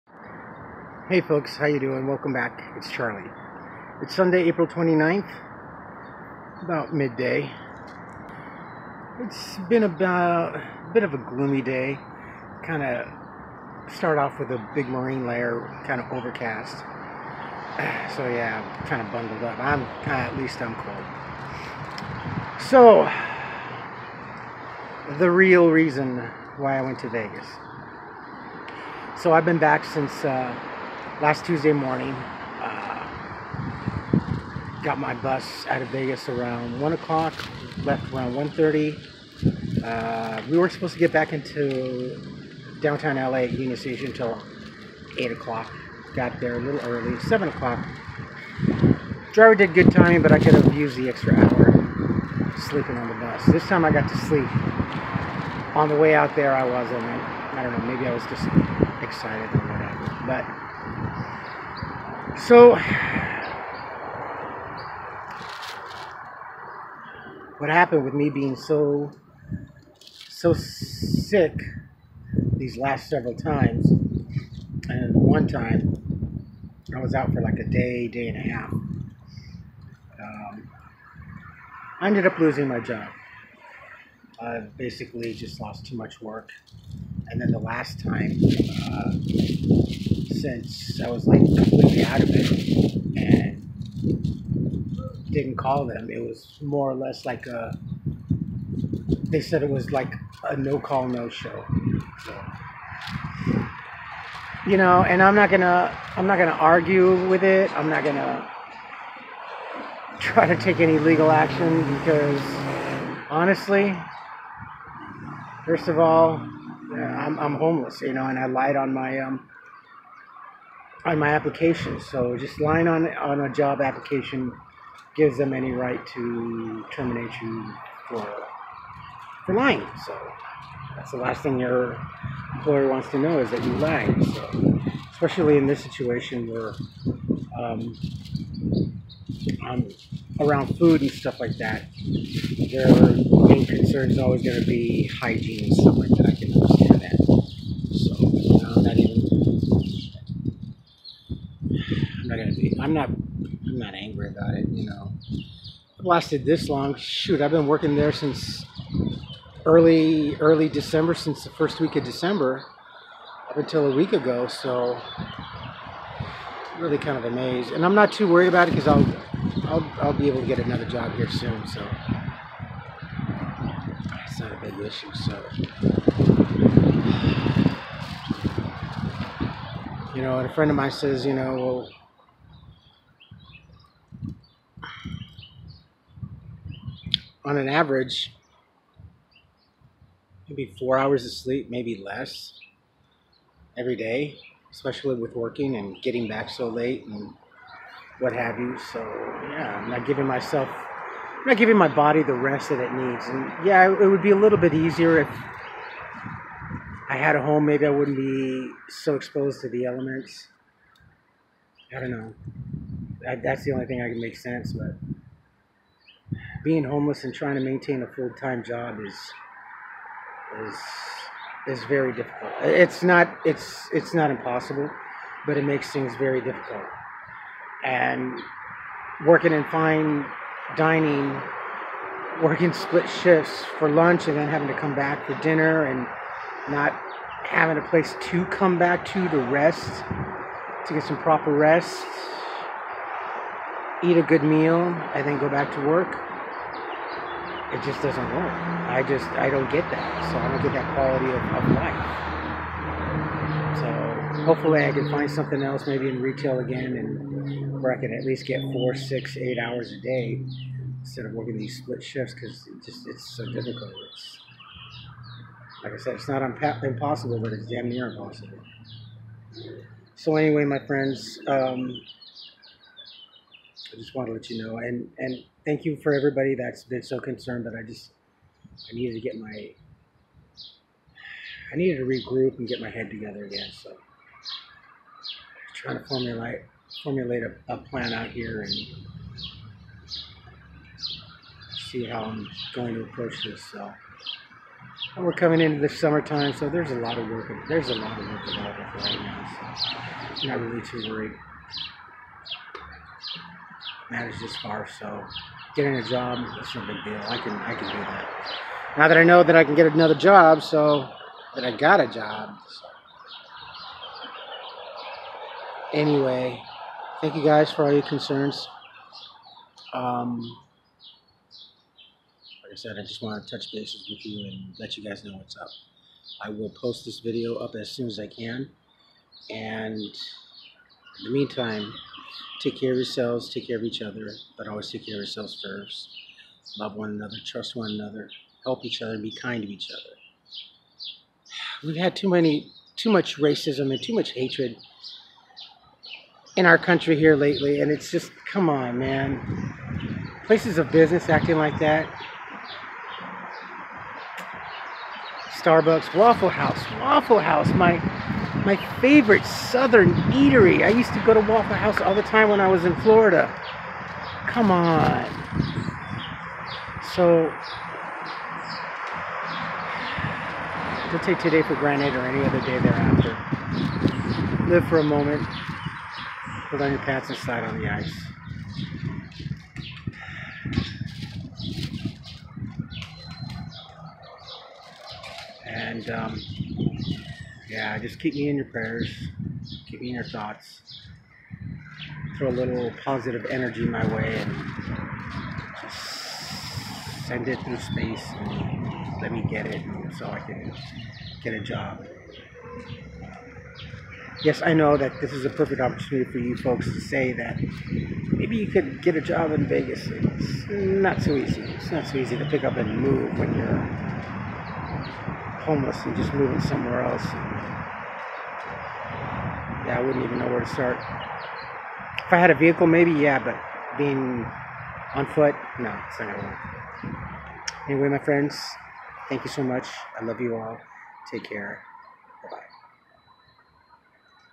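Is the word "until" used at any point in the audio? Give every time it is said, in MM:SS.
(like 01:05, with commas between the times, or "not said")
00:44, 02:43.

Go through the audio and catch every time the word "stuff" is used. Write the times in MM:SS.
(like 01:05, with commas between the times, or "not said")
02:21, 02:25.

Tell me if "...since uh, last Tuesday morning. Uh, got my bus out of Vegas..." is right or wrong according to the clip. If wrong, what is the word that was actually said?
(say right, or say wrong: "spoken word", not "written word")
right.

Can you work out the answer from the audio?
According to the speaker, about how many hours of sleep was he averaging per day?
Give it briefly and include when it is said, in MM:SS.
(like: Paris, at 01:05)
4, at 03:10.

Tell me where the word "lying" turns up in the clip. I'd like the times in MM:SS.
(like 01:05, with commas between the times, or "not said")
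02:02, 02:09.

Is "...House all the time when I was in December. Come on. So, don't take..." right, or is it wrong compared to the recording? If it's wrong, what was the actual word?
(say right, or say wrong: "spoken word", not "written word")
wrong: "Florida", not "December".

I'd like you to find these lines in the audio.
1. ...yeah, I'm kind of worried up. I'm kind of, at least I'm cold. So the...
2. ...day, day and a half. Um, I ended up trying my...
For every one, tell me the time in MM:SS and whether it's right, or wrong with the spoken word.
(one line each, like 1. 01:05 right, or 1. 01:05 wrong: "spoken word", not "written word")
1. 00:18 wrong: "bundled", not "worried"
2. 01:17 wrong: "losing", not "trying".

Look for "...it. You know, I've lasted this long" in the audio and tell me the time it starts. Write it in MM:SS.
02:34.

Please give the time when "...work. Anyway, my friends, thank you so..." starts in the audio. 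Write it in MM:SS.
07:06.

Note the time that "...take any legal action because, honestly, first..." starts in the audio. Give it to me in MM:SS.
01:50.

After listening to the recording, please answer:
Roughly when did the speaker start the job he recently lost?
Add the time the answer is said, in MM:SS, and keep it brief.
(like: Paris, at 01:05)
first week of December, at 02:41.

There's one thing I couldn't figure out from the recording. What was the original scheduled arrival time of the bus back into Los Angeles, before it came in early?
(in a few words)
8 o'clock.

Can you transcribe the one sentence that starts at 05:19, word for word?
Um, like I said, I just want to touch bases with you and let you guys know what's up.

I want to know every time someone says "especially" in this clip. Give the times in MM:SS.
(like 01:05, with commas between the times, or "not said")
02:15, 03:14.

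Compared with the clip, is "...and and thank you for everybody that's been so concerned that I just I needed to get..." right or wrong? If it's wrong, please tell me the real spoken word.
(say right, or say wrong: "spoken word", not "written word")
right.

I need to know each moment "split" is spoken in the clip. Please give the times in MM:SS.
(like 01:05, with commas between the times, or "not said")
03:52, 04:21.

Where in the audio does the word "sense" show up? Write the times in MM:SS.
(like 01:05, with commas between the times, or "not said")
03:34.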